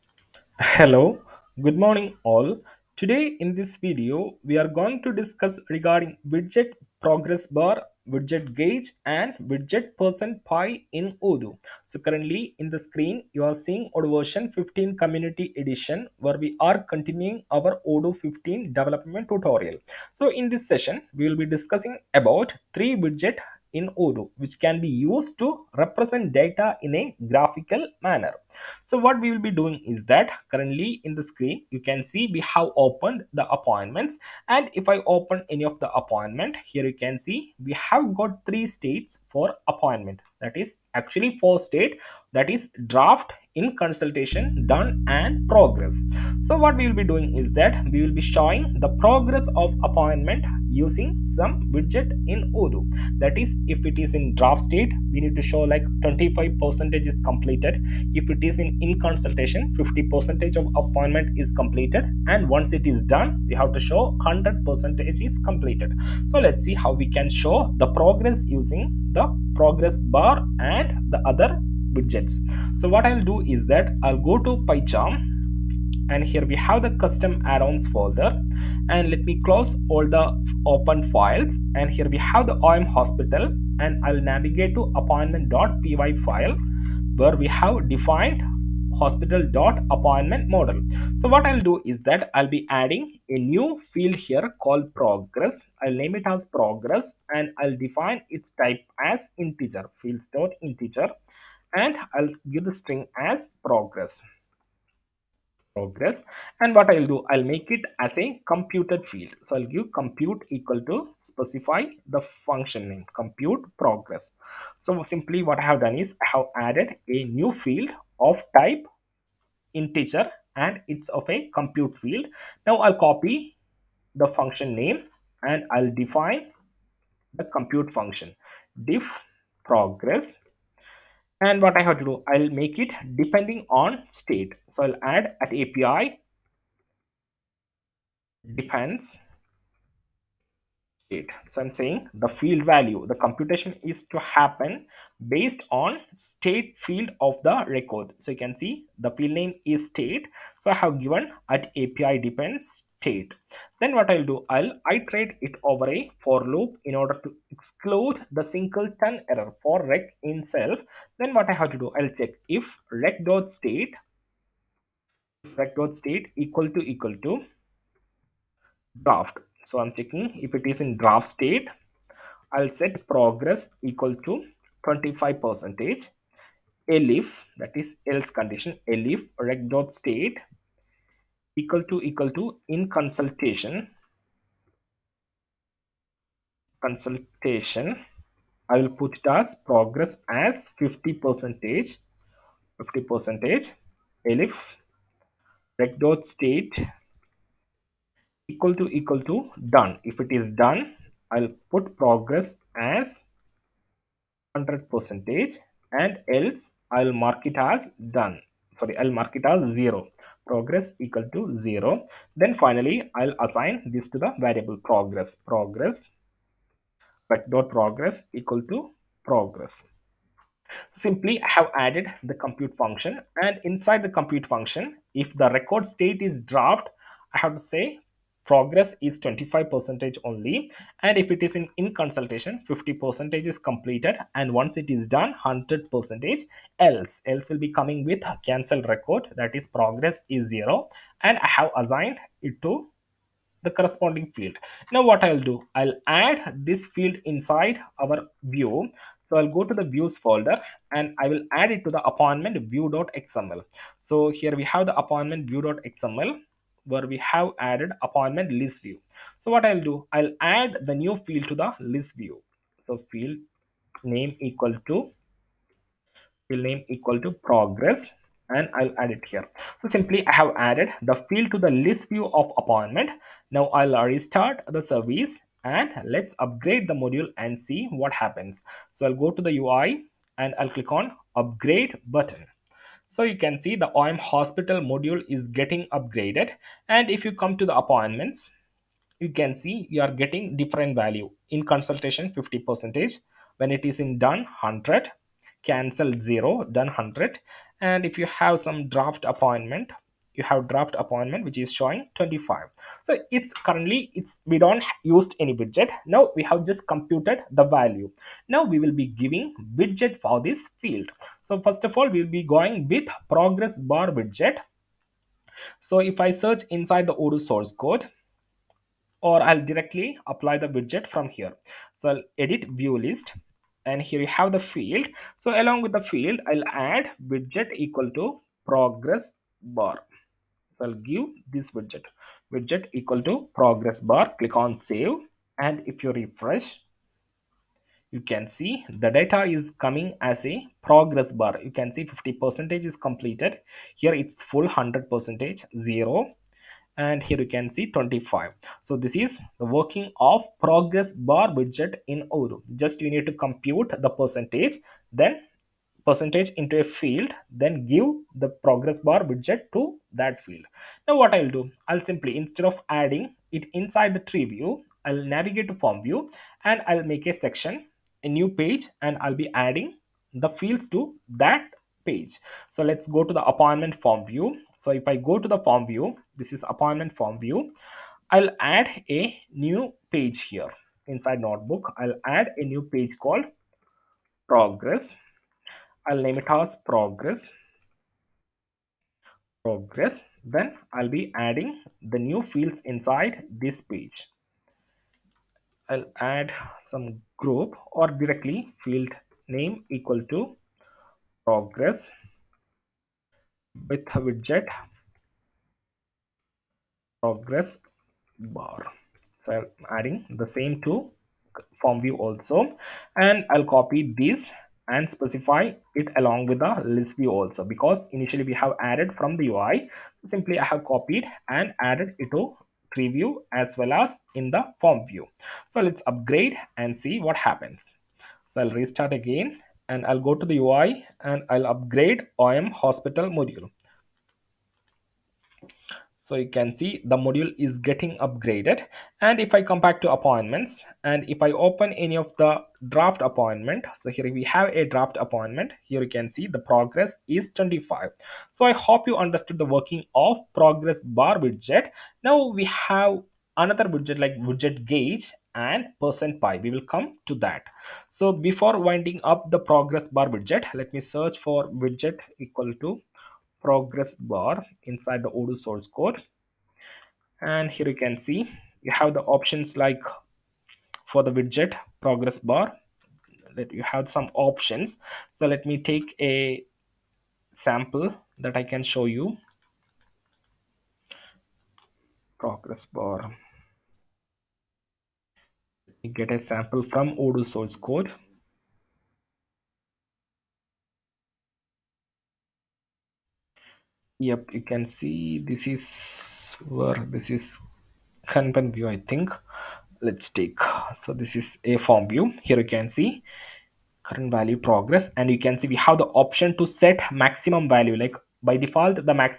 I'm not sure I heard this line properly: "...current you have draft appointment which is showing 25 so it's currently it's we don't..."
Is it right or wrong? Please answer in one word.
wrong.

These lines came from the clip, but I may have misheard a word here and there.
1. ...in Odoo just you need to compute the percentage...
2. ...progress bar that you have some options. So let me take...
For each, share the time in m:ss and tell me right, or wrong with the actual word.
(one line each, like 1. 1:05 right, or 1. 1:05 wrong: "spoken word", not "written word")
1. 5:52 right
2. 7:52 right.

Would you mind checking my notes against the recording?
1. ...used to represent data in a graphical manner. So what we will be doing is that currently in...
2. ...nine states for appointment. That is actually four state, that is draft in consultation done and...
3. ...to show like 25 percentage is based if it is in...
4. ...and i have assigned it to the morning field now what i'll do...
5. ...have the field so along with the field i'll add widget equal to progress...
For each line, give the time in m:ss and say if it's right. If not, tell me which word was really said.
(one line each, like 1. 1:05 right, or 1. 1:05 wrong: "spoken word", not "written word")
1. 0:25 right
2. 0:38 wrong: "three", not "nine"
3. 0:55 wrong: "completed", not "based"
4. 4:01 wrong: "corresponding", not "morning"
5. 5:24 right.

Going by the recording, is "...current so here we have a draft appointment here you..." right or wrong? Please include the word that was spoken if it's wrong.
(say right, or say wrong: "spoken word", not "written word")
wrong: "appointment", not "current".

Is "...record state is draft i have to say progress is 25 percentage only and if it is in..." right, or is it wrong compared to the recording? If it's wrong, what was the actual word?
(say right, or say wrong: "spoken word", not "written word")
right.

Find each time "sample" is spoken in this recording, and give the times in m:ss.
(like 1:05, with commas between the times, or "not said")
7:57, 8:06.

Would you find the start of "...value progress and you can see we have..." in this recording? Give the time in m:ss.
8:24.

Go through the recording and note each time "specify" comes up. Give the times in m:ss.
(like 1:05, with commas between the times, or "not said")
1:51, 6:55.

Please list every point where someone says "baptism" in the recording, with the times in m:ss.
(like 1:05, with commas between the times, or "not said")
not said.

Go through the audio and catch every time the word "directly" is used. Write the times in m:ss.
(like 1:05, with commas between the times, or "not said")
5:19, 6:38.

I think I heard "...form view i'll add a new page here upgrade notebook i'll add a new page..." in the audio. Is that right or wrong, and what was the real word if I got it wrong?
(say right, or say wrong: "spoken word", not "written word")
wrong: "inside", not "upgrade".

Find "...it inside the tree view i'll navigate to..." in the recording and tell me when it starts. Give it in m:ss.
6:03.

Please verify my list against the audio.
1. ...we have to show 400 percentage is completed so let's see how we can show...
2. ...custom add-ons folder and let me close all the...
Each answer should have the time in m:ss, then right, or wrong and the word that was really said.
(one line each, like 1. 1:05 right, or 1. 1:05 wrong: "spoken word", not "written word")
1. 1:03 wrong: "100", not "400"
2. 1:16 right.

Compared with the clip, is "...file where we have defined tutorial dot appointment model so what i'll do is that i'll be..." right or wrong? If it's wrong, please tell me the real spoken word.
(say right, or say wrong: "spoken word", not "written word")
wrong: "hospital", not "tutorial".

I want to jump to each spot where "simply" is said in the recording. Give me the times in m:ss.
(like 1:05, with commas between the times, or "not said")
1:55, 3:40, 4:29, 6:02, 7:00.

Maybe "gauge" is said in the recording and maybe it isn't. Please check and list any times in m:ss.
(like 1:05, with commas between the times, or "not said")
0:08, 7:34.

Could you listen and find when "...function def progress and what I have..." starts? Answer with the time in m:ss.
2:07.